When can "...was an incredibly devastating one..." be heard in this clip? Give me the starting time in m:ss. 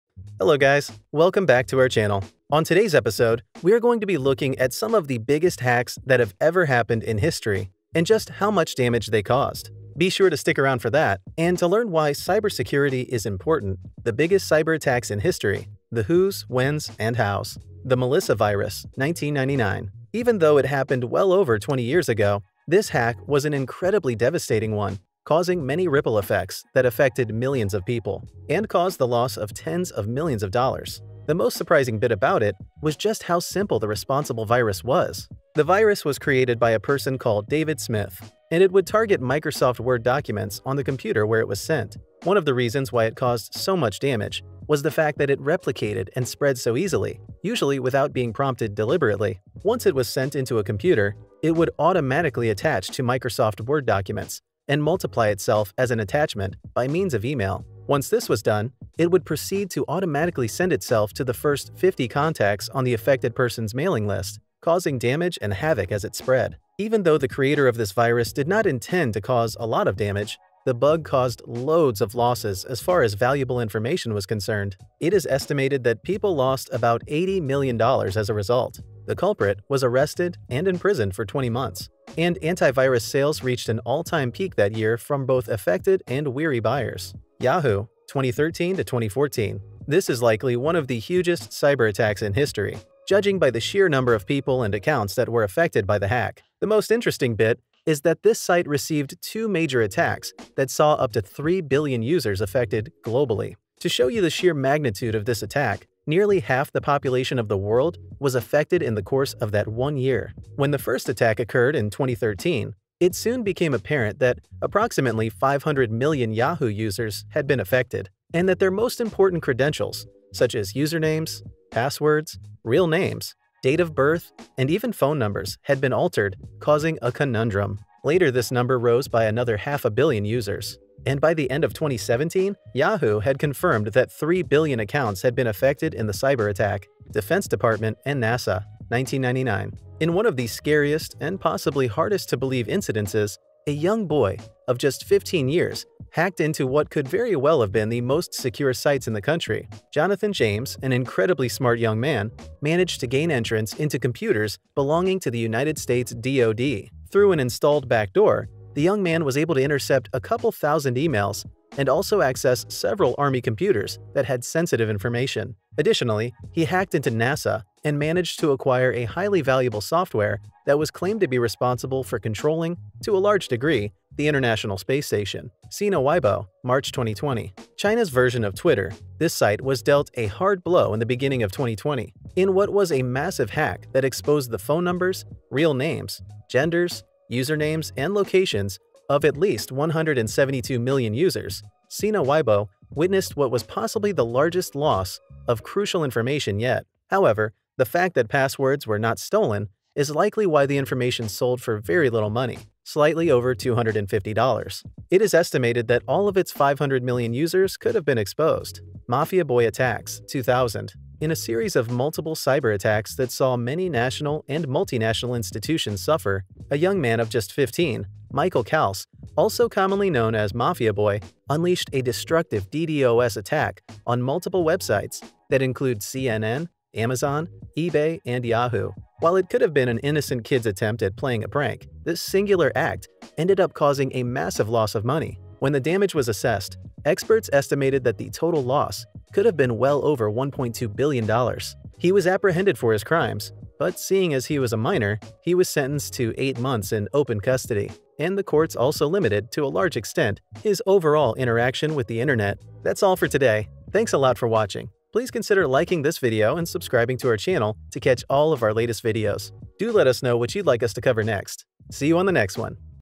0:23.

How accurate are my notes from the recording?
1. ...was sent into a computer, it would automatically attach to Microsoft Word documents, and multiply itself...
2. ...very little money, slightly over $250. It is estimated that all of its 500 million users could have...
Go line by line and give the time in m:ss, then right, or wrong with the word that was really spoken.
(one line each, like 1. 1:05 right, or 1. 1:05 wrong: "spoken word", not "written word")
1. 0:49 right
2. 3:21 right.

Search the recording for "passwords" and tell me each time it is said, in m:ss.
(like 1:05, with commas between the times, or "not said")
2:01, 3:18.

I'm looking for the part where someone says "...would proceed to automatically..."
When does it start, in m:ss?
0:59.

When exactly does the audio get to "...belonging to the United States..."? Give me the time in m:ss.
2:34.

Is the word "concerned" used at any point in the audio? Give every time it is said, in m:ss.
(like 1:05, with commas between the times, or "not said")
1:14.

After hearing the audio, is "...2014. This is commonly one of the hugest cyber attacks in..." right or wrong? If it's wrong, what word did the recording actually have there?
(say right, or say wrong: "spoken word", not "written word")
wrong: "likely", not "commonly".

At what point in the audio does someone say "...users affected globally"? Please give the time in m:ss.
1:42.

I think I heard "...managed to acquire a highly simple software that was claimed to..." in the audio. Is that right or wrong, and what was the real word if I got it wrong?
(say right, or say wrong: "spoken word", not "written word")
wrong: "valuable", not "simple".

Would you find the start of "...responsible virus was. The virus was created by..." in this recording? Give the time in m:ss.
0:33.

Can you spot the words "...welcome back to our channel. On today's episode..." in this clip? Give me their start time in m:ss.
0:01.